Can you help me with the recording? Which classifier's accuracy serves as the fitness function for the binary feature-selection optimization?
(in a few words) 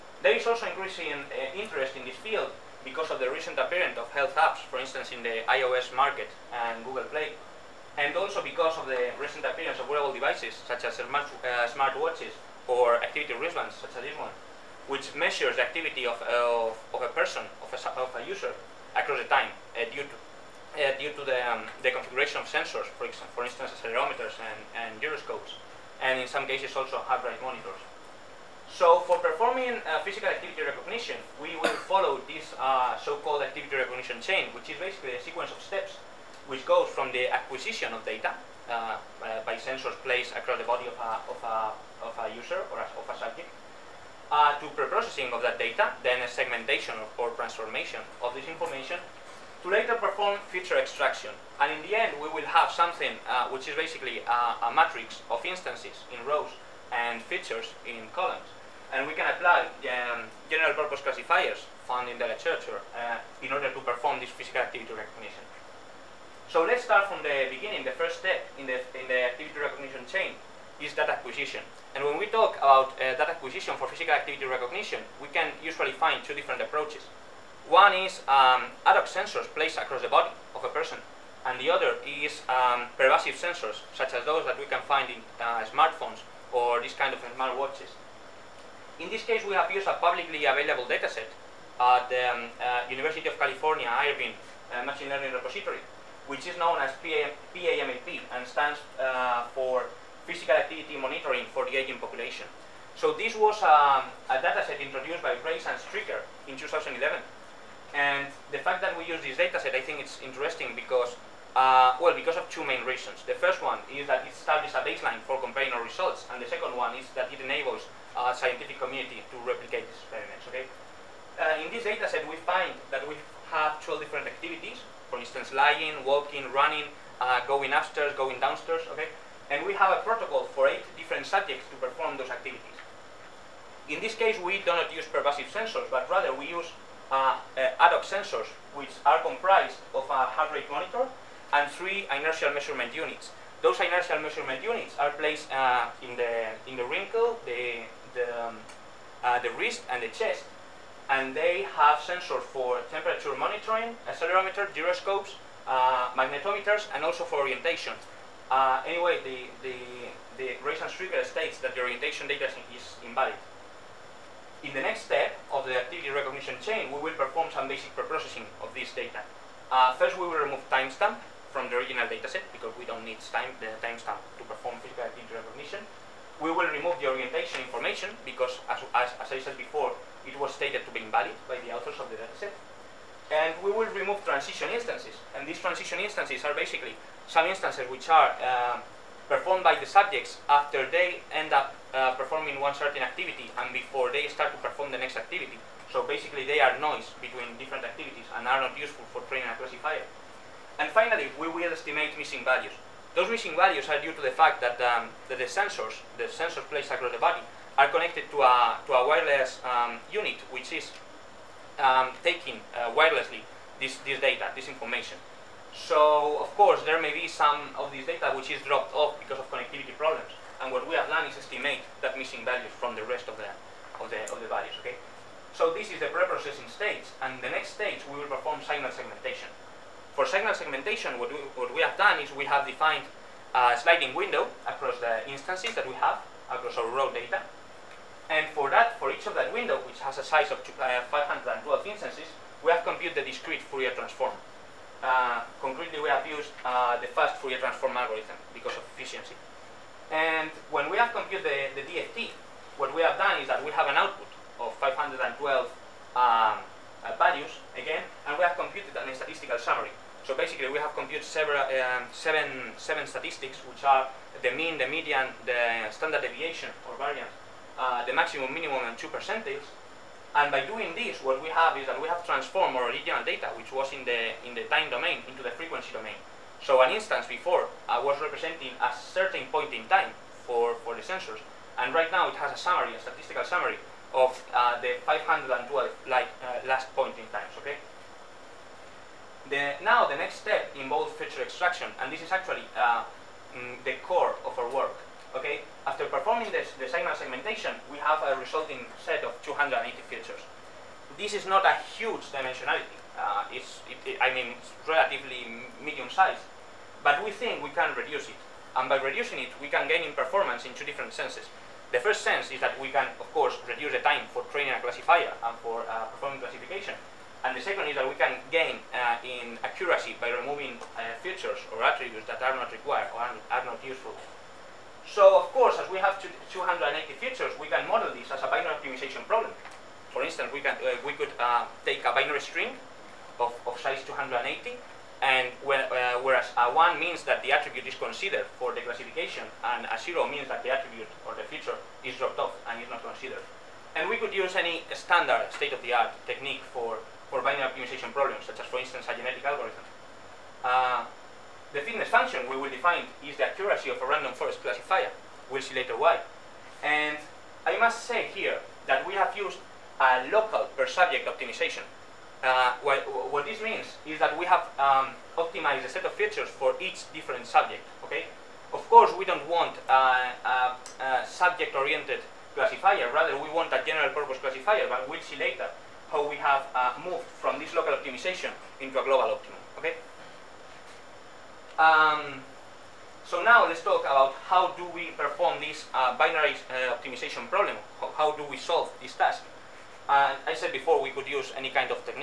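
random forest.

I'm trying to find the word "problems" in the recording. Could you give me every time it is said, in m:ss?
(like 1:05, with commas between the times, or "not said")
3:39, 5:29, 5:48, 6:27.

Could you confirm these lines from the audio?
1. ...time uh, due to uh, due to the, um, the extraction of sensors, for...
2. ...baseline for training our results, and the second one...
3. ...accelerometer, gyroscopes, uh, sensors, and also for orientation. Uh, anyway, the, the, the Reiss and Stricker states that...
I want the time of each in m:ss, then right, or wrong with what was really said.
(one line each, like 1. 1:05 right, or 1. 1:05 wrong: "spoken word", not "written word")
1. 0:19 wrong: "configuration", not "extraction"
2. 1:54 wrong: "comparing", not "training"
3. 2:34 wrong: "magnetometers", not "sensors".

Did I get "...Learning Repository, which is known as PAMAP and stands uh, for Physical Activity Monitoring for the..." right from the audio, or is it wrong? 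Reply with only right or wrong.
right.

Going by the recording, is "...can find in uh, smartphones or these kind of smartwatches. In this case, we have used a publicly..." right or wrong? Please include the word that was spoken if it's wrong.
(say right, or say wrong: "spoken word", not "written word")
right.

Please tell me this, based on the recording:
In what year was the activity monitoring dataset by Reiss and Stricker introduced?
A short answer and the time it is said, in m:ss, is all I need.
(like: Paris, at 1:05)
2011, at 1:46.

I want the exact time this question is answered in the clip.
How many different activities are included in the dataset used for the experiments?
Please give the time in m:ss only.
2:03.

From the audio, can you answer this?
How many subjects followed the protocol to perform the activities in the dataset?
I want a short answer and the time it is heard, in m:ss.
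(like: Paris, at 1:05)
8, at 2:10.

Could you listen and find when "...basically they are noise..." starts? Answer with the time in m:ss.
3:16.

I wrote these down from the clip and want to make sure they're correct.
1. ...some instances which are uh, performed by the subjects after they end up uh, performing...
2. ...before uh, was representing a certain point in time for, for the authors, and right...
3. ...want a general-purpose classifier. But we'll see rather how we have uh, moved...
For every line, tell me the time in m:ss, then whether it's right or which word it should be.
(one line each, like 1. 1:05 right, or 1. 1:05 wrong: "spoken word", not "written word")
1. 3:07 right
2. 4:37 wrong: "sensors", not "authors"
3. 6:13 wrong: "later", not "rather".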